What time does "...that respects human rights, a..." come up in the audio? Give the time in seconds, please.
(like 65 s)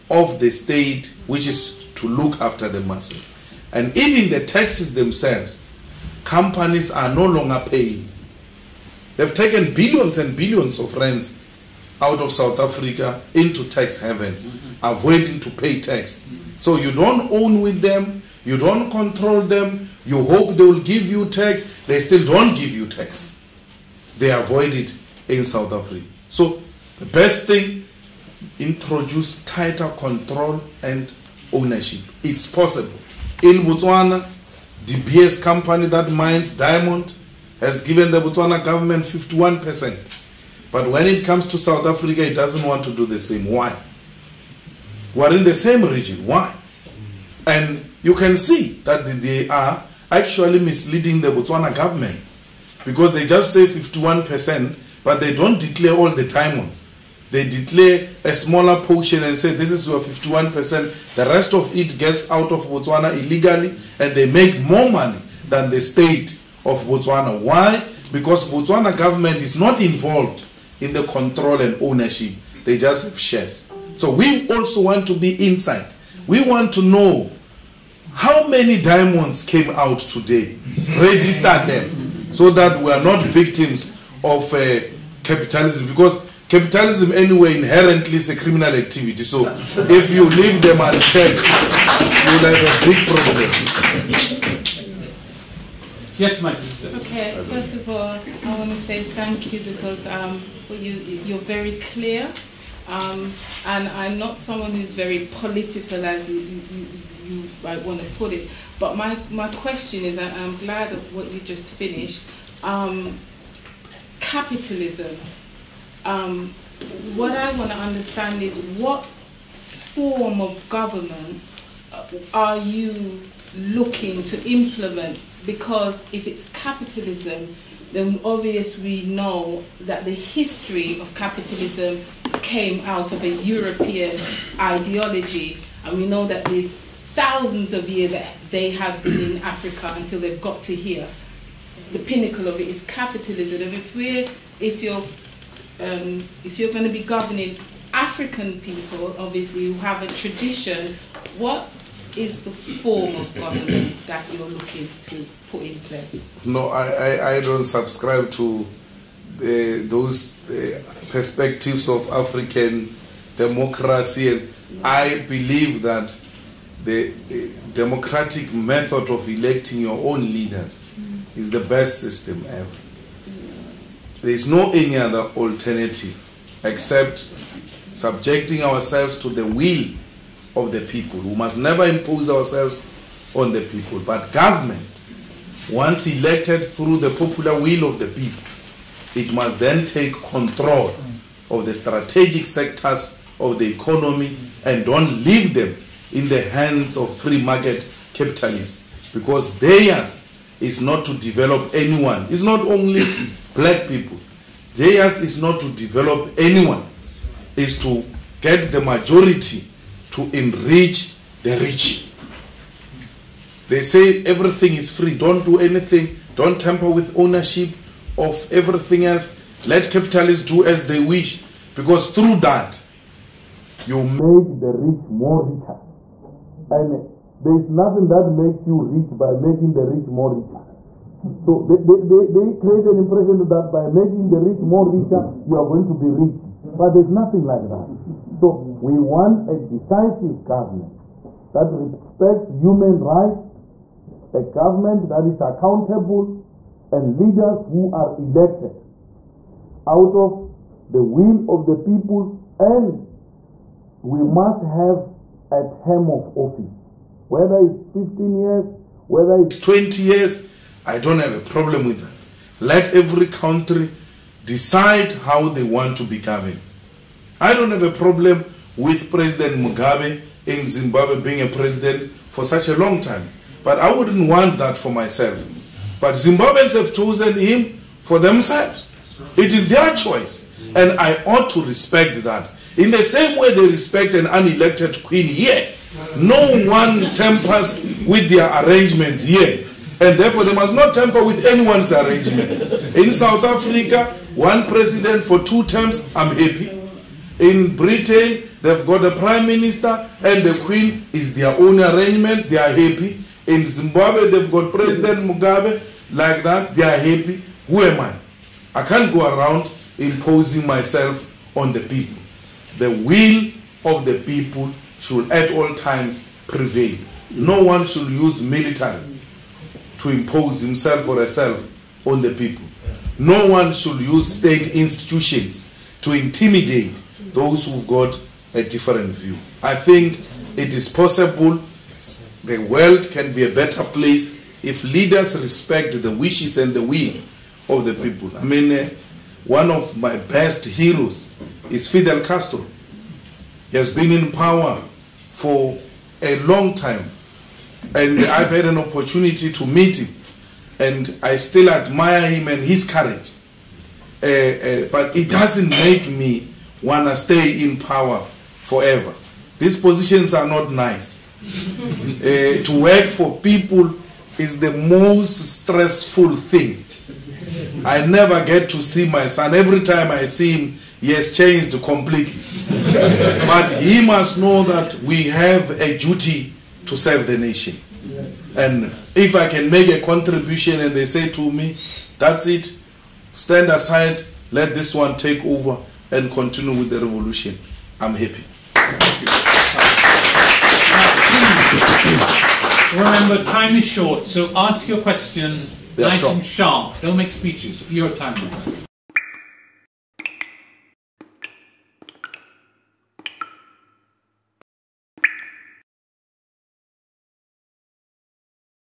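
241 s.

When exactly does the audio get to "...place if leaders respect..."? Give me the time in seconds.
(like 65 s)
333 s.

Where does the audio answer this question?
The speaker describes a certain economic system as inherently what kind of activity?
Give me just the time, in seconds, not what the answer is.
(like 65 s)
88 s.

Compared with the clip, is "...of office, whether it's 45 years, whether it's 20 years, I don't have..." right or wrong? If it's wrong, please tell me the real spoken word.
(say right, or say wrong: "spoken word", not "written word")
wrong: "15", not "45".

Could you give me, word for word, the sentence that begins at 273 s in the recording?
But I wouldn't want that for myself.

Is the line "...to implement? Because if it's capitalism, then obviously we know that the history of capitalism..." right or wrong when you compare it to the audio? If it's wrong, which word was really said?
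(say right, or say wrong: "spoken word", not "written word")
right.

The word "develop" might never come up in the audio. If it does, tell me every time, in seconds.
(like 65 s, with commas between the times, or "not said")
201 s, 205 s.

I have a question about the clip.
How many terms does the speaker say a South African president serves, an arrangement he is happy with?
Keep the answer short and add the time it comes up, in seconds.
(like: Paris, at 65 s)
2, at 295 s.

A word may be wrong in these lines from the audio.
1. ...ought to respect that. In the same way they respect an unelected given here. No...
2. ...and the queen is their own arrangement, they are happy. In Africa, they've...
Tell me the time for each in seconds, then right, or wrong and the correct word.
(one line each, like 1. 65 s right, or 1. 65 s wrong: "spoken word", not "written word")
1. 281 s wrong: "queen", not "given"
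2. 300 s wrong: "Zimbabwe", not "Africa".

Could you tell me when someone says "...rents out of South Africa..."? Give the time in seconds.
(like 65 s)
10 s.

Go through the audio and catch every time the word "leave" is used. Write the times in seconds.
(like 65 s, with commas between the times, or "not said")
90 s, 195 s.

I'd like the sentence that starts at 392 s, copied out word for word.
Remember, time is short, so ask your question yeah, nice sure.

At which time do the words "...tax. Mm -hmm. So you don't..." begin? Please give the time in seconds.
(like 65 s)
15 s.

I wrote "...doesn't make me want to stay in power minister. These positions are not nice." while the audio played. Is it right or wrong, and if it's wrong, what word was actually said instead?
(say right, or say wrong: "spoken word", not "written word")
wrong: "forever", not "minister".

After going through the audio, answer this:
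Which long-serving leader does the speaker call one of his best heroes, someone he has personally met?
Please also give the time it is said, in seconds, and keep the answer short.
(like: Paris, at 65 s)
Fidel Castro, at 341 s.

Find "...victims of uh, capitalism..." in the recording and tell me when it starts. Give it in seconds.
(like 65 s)
83 s.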